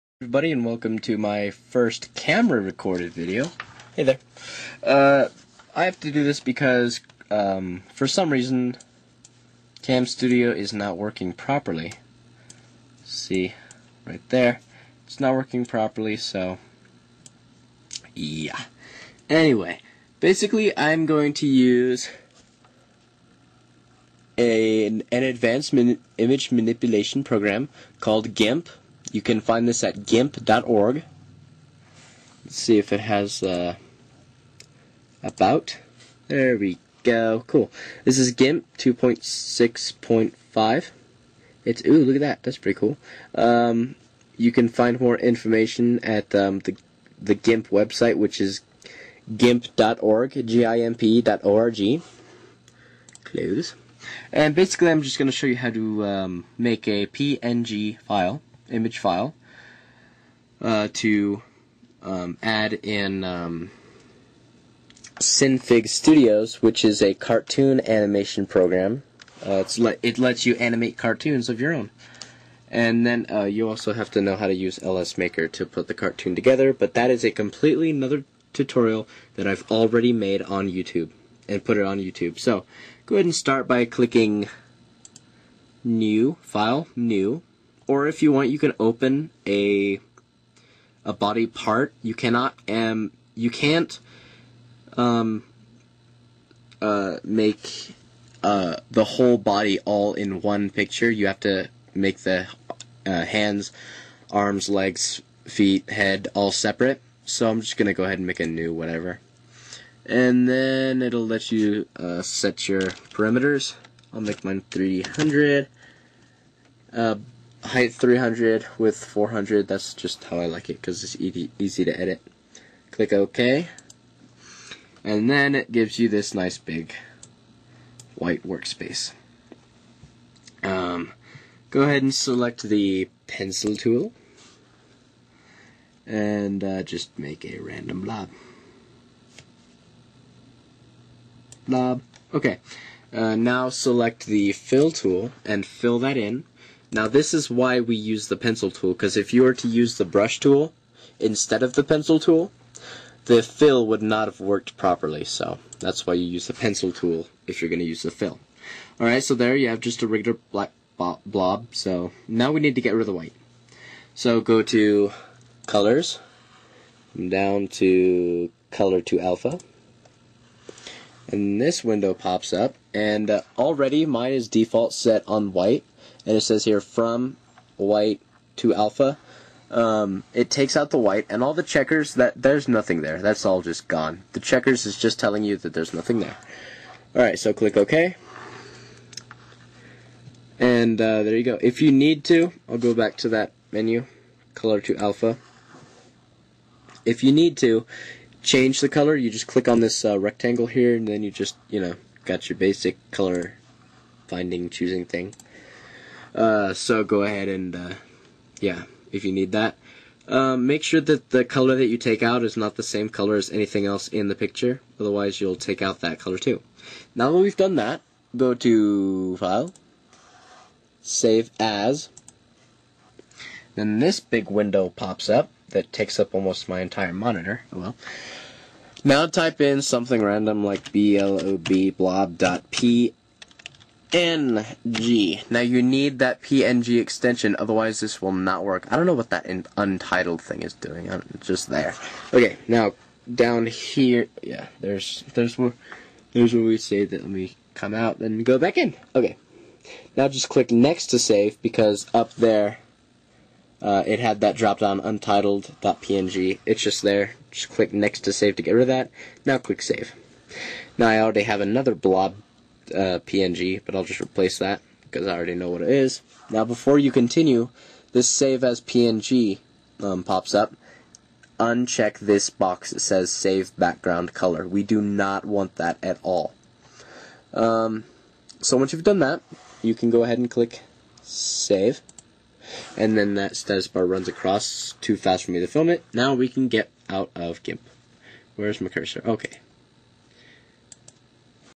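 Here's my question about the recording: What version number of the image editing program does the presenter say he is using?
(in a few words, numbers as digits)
2.6.5.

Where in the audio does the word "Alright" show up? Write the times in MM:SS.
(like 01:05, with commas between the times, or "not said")
02:38.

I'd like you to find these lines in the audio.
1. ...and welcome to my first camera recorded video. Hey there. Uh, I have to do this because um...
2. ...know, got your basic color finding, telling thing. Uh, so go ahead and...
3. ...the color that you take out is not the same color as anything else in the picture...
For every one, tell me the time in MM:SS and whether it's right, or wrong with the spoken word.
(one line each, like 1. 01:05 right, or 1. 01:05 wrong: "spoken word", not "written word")
1. 00:00 right
2. 03:21 wrong: "choosing", not "telling"
3. 03:31 right.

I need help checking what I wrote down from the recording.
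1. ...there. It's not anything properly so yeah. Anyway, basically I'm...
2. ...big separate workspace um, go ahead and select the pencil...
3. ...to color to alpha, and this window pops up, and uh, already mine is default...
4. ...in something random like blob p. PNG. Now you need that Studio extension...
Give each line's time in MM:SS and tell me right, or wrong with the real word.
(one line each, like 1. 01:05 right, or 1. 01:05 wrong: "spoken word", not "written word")
1. 00:14 wrong: "working", not "anything"
2. 02:06 wrong: "white", not "separate"
3. 02:47 right
4. 03:49 wrong: "PNG", not "Studio".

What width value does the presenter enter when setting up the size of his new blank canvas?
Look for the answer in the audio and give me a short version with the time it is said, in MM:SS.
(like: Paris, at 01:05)
400, at 01:59.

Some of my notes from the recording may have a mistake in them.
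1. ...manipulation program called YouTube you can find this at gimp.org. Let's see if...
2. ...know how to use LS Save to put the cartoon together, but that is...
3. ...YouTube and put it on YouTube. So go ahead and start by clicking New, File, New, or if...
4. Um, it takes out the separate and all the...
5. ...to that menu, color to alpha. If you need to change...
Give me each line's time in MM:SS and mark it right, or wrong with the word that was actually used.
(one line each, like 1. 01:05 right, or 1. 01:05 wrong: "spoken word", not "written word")
1. 00:26 wrong: "GIMP", not "YouTube"
2. 01:14 wrong: "Maker", not "Save"
3. 01:20 right
4. 02:59 wrong: "white", not "separate"
5. 03:13 right.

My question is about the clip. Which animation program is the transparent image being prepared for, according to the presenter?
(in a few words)
Synfig Studios.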